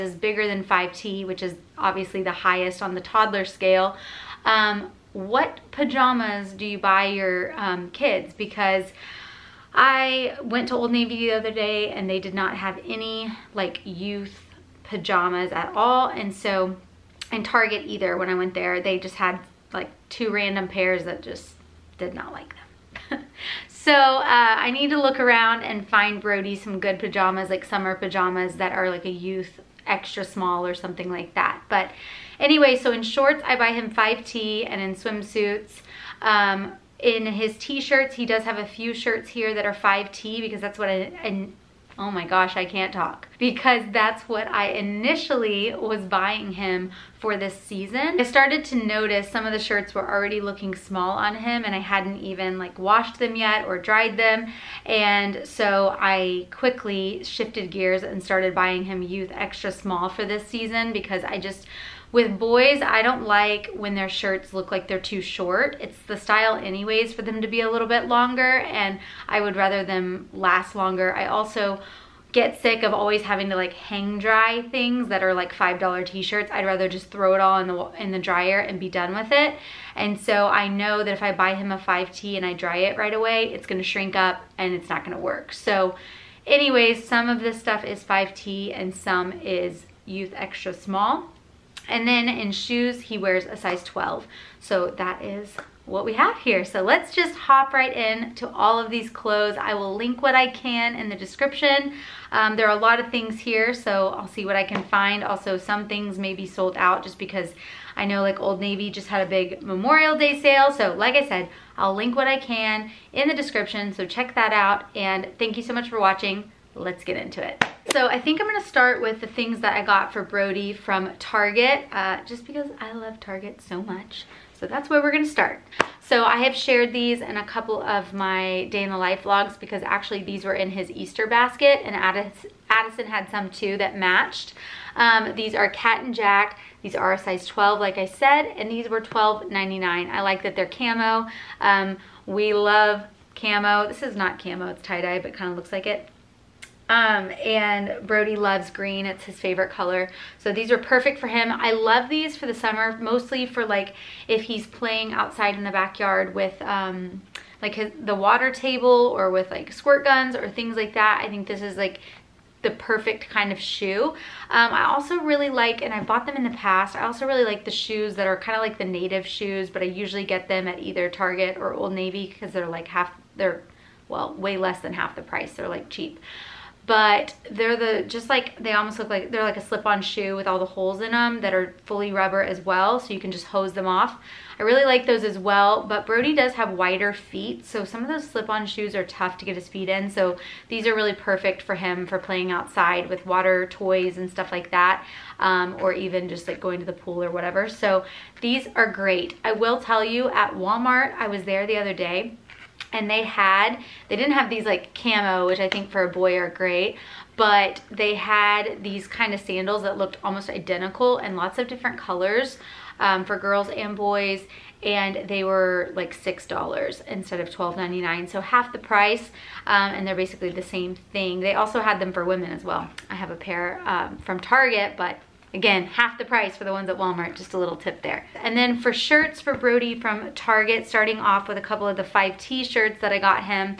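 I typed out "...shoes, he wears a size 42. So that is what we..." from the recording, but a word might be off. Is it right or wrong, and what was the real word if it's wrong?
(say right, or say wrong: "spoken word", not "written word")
wrong: "12", not "42".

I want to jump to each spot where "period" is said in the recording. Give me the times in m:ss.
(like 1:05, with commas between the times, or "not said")
not said.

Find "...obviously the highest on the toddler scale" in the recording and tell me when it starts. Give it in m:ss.
0:01.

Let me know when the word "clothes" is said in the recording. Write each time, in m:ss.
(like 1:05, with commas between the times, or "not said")
1:39.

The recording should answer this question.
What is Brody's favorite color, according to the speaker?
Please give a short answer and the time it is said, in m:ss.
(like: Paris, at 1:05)
Green, at 2:28.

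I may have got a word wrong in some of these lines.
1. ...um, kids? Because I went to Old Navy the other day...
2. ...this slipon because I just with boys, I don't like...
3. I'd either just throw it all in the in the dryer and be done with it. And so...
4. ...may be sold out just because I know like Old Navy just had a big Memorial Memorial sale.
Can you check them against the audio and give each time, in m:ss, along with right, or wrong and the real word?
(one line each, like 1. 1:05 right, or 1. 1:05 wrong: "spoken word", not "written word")
1. 0:07 right
2. 1:00 wrong: "season", not "slipon"
3. 1:16 wrong: "rather", not "either"
4. 1:46 wrong: "Day", not "Memorial".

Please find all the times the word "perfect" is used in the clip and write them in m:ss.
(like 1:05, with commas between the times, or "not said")
2:30, 2:42, 3:11.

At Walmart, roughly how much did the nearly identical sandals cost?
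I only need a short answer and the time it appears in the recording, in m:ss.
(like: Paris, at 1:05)
$6, at 3:36.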